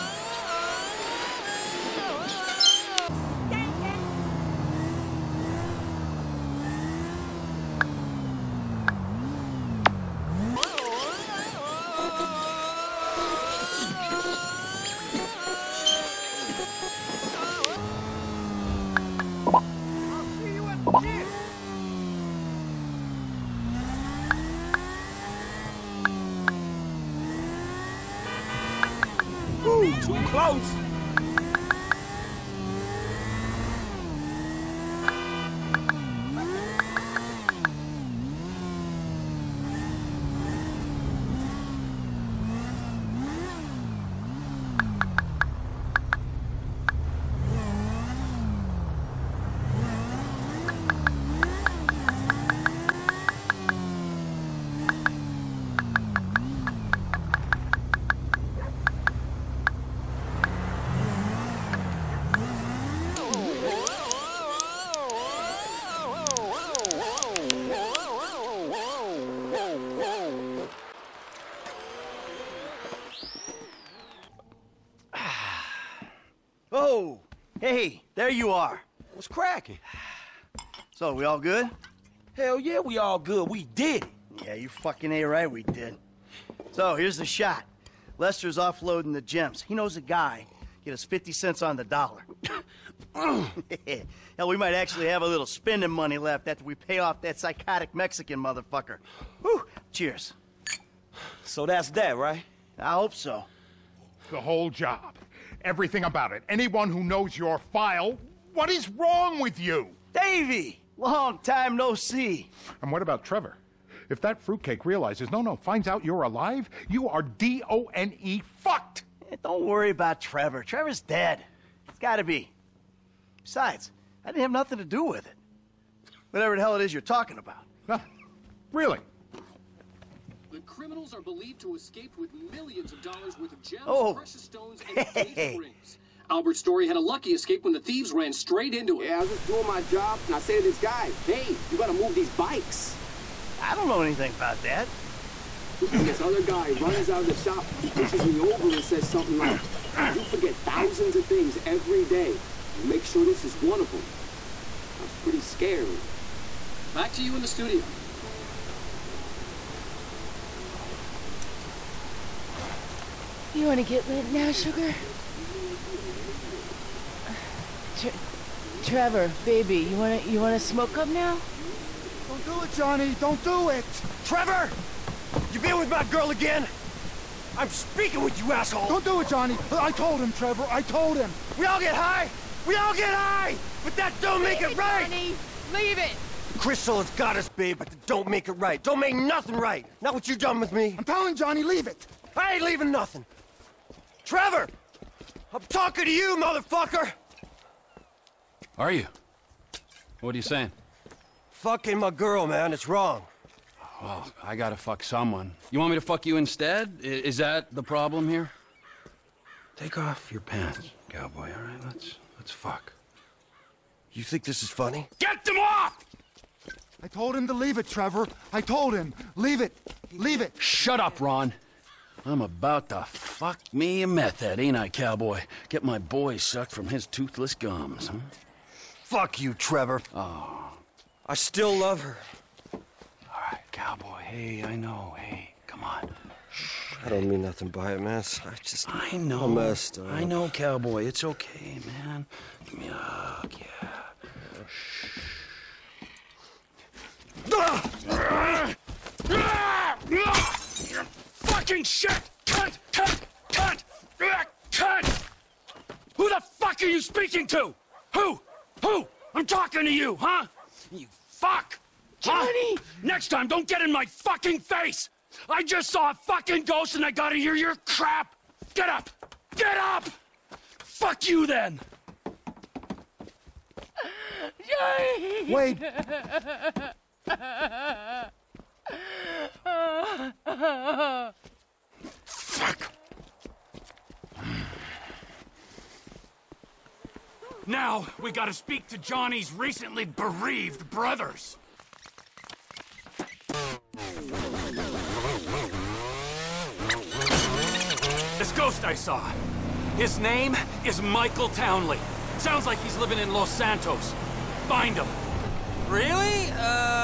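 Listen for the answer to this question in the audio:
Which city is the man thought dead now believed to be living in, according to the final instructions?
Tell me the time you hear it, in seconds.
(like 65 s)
303 s.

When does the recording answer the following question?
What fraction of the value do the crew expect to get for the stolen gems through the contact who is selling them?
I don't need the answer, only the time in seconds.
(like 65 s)
91 s.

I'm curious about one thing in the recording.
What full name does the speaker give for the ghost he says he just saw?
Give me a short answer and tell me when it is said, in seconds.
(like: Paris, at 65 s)
Michael Townley, at 301 s.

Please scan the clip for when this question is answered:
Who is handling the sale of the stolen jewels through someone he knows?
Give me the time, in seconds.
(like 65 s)
88 s.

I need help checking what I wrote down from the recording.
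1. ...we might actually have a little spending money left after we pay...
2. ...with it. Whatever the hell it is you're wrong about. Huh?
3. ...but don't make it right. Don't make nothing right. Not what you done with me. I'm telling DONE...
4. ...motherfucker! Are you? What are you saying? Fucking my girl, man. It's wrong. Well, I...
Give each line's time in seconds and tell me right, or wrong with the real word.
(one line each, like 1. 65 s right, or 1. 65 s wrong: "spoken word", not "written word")
1. 94 s right
2. 125 s wrong: "talking", not "wrong"
3. 187 s wrong: "Johnny", not "DONE"
4. 196 s right.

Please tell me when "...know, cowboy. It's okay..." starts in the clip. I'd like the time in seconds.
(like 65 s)
240 s.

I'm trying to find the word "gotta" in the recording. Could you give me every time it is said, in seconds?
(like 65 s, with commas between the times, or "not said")
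121 s, 141 s, 204 s, 267 s, 288 s.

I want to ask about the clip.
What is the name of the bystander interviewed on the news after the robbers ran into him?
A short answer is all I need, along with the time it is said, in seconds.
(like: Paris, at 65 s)
Albert Story, at 136 s.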